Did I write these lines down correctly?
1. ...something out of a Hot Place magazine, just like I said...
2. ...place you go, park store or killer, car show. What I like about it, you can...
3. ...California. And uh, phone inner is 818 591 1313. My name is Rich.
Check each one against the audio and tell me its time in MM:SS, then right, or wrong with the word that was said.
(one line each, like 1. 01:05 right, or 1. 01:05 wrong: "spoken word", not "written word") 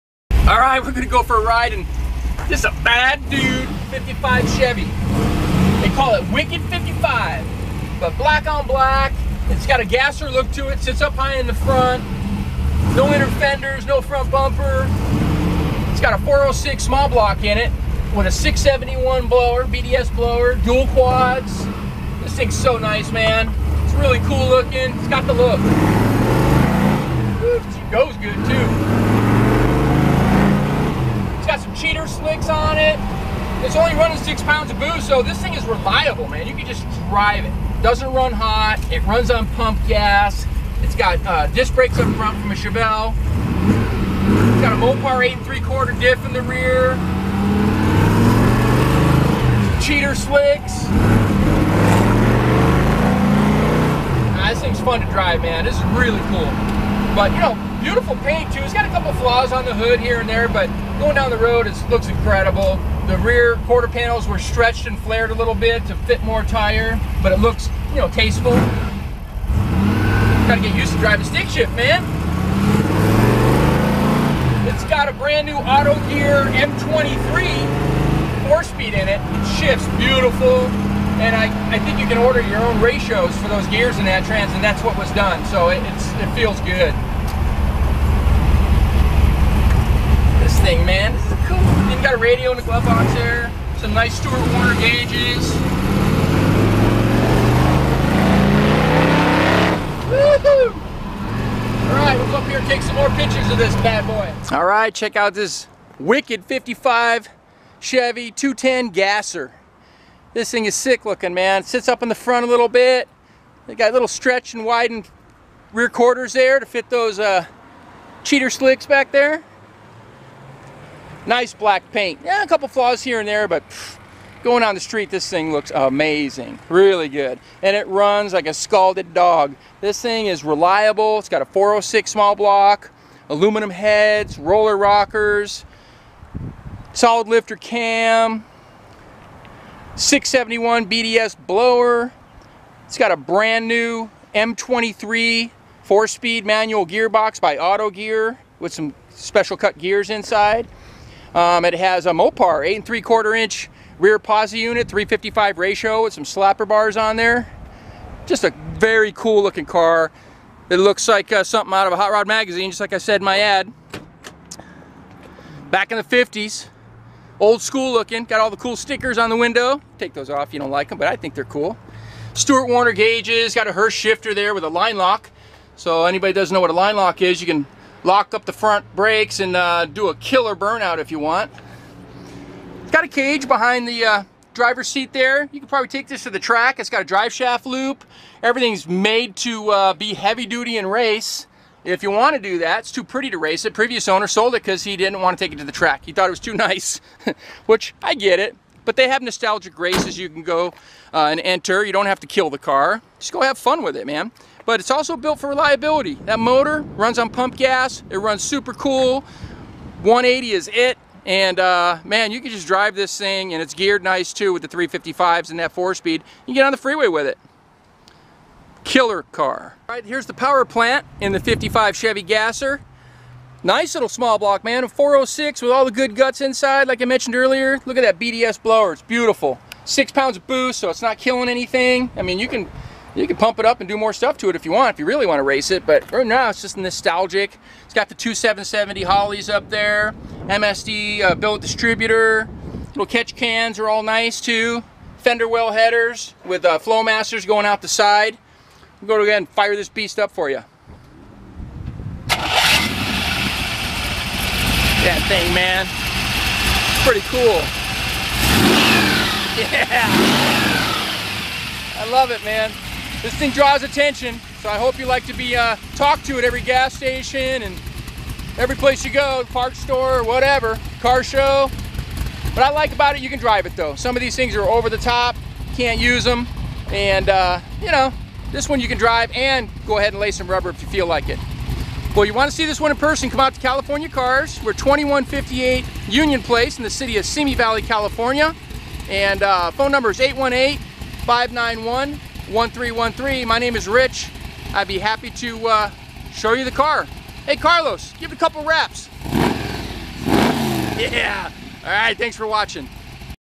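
1. 02:41 wrong: "Rod", not "Place"
2. 04:28 wrong: "whatever", not "killer"
3. 04:47 wrong: "number", not "inner".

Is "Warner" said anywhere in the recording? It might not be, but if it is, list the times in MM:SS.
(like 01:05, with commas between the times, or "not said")
01:34, 02:52.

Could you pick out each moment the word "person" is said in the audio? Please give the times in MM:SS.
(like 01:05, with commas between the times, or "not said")
04:42.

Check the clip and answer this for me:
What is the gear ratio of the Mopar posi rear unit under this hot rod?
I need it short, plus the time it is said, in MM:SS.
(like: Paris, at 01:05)
3.55, at 02:34.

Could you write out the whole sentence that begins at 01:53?
They got little stretch and widened rear quarters there to fit those uh, cheater slicks back there.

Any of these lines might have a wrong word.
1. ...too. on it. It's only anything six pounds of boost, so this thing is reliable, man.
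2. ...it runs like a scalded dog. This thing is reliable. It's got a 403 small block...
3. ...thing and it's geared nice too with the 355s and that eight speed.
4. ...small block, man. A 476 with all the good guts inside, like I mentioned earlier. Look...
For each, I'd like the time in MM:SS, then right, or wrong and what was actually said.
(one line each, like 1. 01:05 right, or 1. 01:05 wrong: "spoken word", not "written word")
1. 00:28 wrong: "running", not "anything"
2. 02:07 wrong: "406", not "403"
3. 03:33 wrong: "four", not "eight"
4. 03:44 wrong: "406", not "476".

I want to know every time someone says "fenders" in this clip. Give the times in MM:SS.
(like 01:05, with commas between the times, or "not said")
00:13, 04:05.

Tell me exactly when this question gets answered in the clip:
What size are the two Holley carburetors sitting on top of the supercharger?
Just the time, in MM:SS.
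03:58.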